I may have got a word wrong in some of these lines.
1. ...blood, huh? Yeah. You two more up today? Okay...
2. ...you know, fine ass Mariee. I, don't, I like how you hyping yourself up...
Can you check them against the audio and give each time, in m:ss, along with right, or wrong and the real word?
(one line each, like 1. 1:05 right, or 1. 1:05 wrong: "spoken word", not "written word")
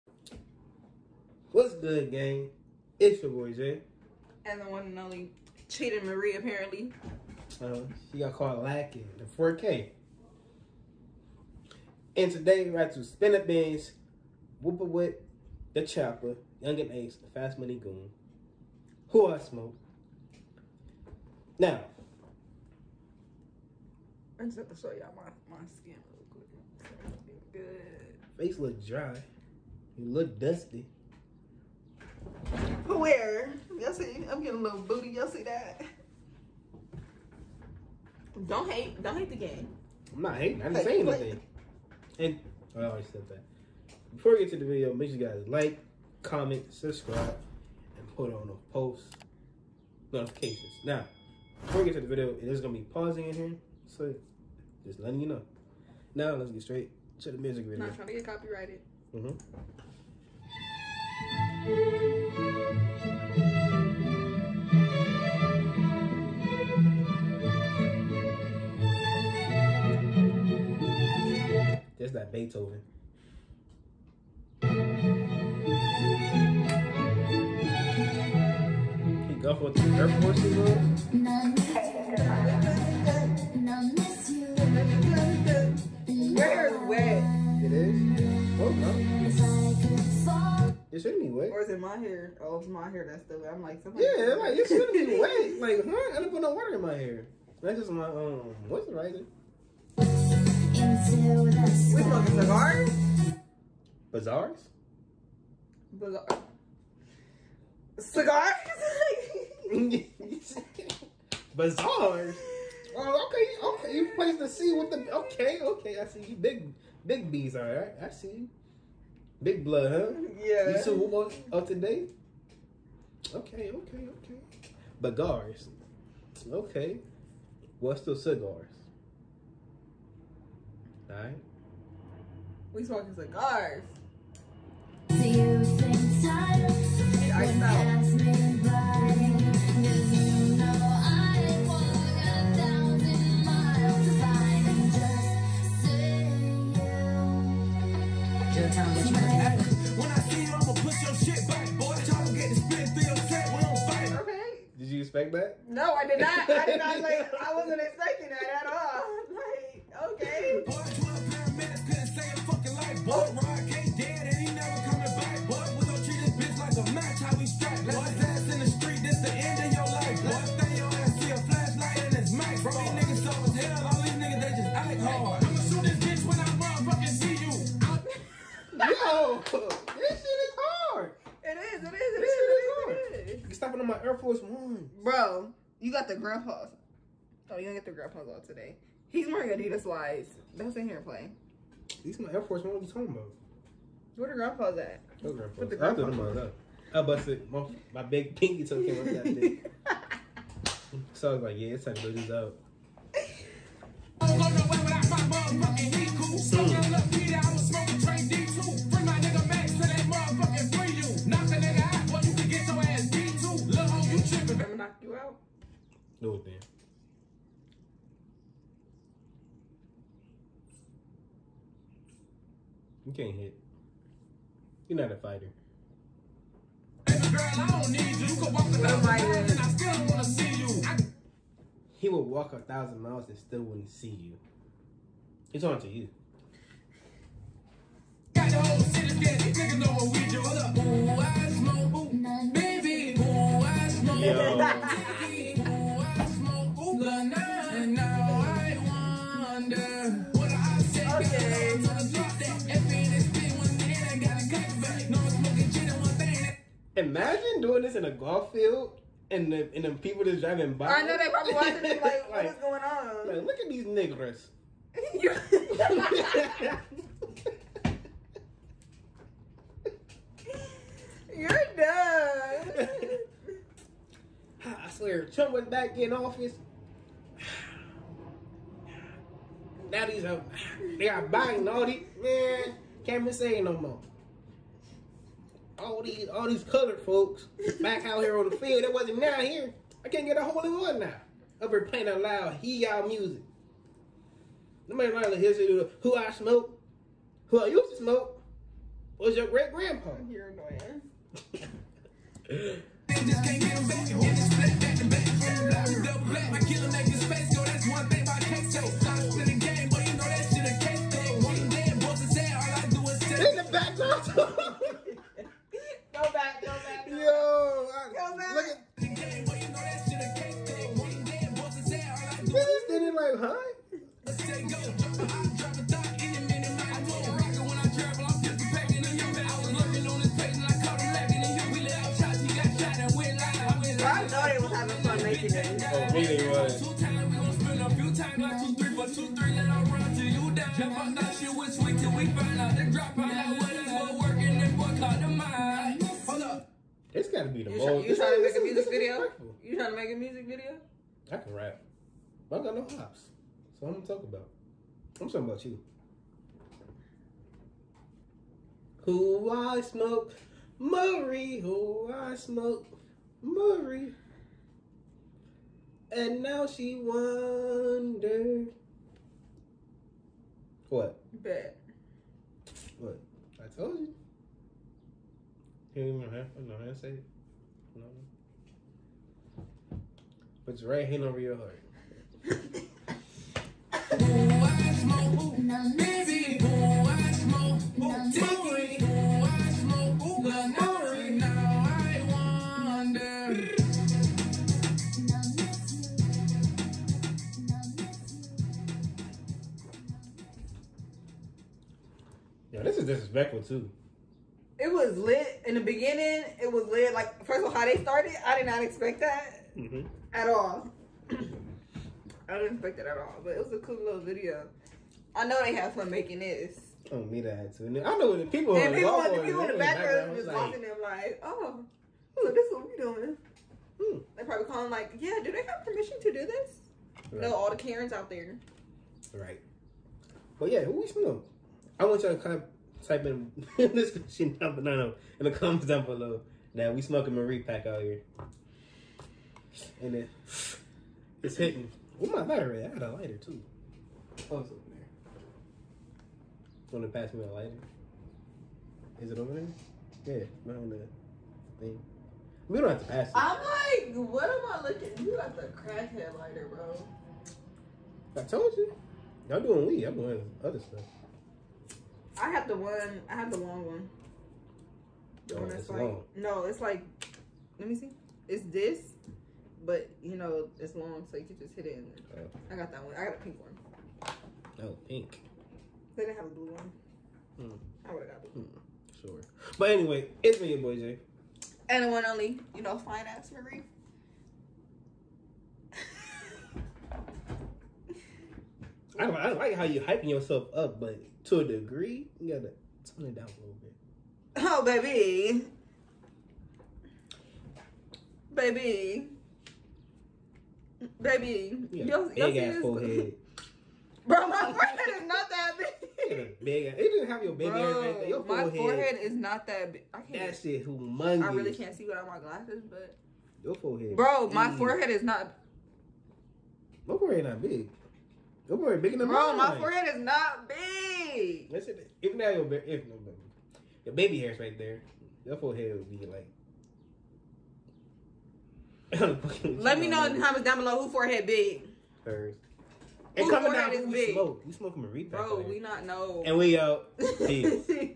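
1. 1:59 right
2. 8:02 right.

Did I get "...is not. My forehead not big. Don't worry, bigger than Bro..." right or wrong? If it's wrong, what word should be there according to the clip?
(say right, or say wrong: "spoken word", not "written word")
right.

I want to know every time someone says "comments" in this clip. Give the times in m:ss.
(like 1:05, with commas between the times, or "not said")
0:46, 7:15, 8:50.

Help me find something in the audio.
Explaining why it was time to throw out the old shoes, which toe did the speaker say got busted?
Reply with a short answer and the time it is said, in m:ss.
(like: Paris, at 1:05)
pinky toe, at 3:18.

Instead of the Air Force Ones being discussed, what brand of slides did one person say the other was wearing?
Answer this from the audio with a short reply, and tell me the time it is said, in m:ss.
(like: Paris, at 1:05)
Adidas, at 3:09.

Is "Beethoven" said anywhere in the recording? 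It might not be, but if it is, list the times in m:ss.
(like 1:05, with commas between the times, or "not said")
1:12.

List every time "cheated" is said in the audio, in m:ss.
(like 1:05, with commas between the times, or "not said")
0:05.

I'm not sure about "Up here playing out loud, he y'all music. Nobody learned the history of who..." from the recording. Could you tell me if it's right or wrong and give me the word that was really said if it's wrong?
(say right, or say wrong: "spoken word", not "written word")
right.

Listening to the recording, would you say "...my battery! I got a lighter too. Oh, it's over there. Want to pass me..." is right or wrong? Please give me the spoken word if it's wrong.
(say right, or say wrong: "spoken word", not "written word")
right.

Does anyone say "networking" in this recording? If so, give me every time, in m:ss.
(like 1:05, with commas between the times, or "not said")
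not said.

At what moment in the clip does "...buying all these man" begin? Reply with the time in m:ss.
4:41.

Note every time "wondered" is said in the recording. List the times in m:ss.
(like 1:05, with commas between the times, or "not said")
6:07.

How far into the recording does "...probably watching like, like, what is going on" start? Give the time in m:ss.
4:21.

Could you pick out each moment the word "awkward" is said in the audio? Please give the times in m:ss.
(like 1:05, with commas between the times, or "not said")
not said.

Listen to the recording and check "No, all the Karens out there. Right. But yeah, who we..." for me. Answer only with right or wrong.
right.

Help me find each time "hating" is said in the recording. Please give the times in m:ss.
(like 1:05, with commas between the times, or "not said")
0:40.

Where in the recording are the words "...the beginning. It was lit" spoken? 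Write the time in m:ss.
6:45.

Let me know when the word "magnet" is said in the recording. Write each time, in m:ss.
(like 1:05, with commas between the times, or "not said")
not said.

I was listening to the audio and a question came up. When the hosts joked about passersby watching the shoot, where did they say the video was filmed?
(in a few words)
golf field.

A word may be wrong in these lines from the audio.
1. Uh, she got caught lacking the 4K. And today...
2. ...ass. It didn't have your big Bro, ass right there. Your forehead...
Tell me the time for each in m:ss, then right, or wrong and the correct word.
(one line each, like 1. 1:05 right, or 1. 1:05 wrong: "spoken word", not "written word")
1. 0:07 right
2. 8:26 right.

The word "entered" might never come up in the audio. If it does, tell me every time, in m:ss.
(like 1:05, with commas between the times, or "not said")
not said.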